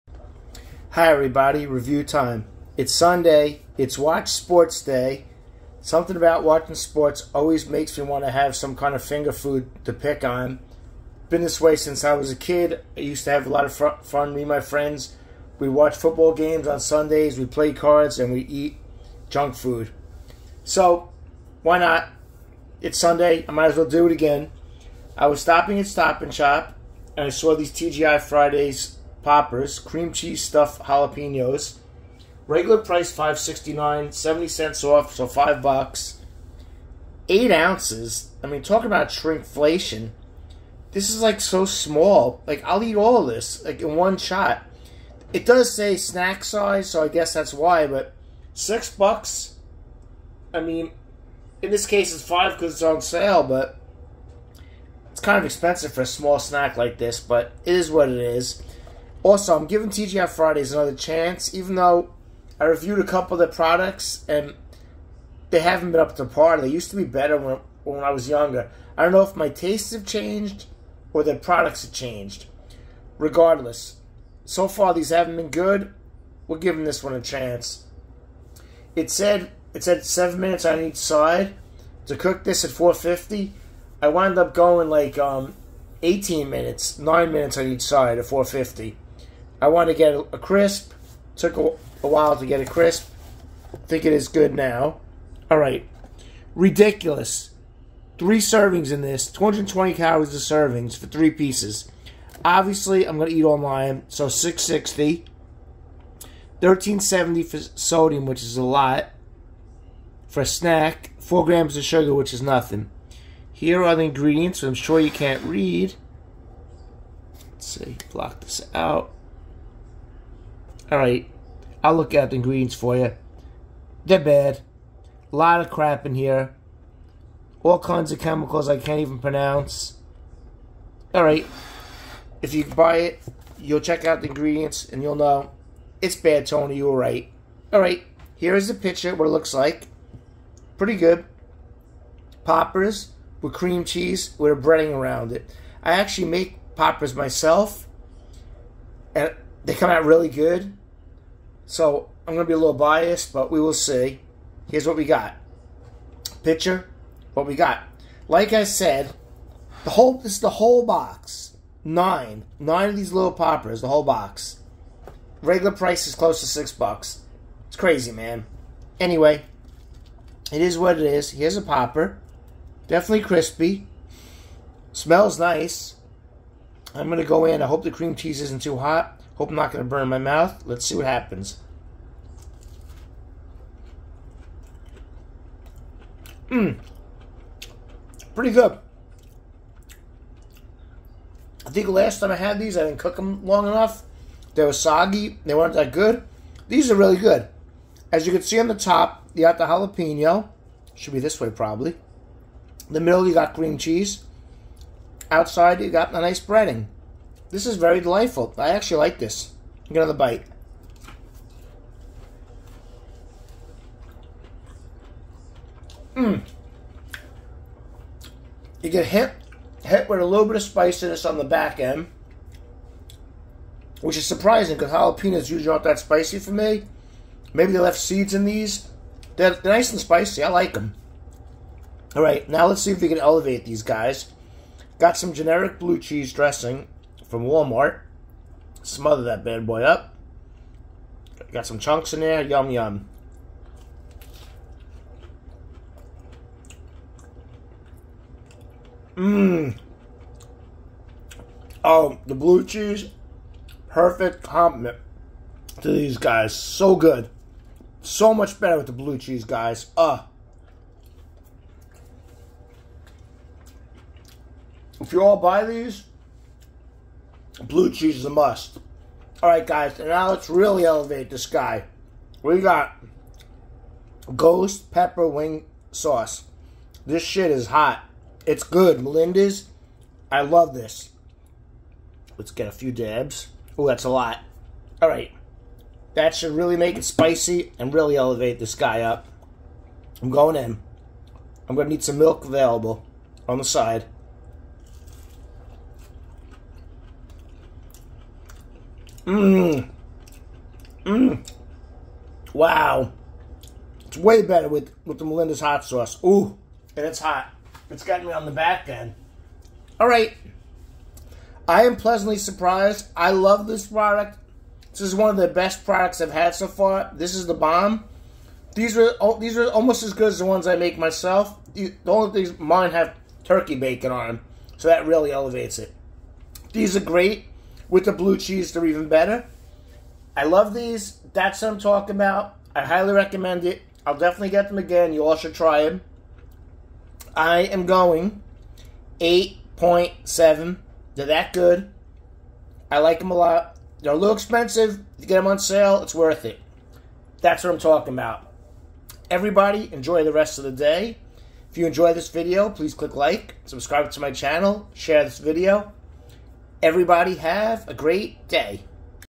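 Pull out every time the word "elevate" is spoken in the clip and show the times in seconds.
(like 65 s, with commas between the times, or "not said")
233 s, 270 s, 288 s, 325 s.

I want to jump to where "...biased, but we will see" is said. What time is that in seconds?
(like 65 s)
152 s.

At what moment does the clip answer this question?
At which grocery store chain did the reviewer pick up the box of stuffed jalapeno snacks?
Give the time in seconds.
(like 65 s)
25 s.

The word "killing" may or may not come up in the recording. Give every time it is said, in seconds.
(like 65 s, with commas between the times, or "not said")
not said.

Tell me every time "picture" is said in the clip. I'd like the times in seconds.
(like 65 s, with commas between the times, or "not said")
138 s, 156 s.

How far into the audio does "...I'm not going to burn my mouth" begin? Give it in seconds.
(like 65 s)
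179 s.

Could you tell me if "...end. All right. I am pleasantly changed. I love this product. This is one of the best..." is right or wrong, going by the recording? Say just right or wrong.
wrong.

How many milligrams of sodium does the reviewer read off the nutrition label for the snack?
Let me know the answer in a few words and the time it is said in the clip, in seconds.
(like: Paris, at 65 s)
1370, at 106 s.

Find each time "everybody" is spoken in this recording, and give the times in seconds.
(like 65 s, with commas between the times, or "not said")
1 s, 349 s, 356 s.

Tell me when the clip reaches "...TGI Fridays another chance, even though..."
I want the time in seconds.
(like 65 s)
59 s.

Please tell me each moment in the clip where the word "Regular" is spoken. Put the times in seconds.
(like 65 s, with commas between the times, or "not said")
32 s, 165 s.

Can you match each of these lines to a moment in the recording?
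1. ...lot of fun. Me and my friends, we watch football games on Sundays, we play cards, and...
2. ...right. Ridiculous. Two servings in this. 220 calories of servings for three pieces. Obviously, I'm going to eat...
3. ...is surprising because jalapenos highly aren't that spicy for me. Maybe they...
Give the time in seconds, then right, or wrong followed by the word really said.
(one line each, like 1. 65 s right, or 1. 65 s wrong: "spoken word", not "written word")
1. 13 s right
2. 95 s wrong: "Three", not "Two"
3. 224 s wrong: "usually", not "highly".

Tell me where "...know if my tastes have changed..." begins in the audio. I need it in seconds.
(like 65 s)
69 s.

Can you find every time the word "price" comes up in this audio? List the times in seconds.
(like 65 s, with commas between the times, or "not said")
32 s, 165 s.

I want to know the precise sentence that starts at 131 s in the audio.
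All right, if you buy it, you'll check out the ingredients and you'll know it's bad, Tony.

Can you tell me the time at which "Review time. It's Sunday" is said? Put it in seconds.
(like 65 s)
1 s.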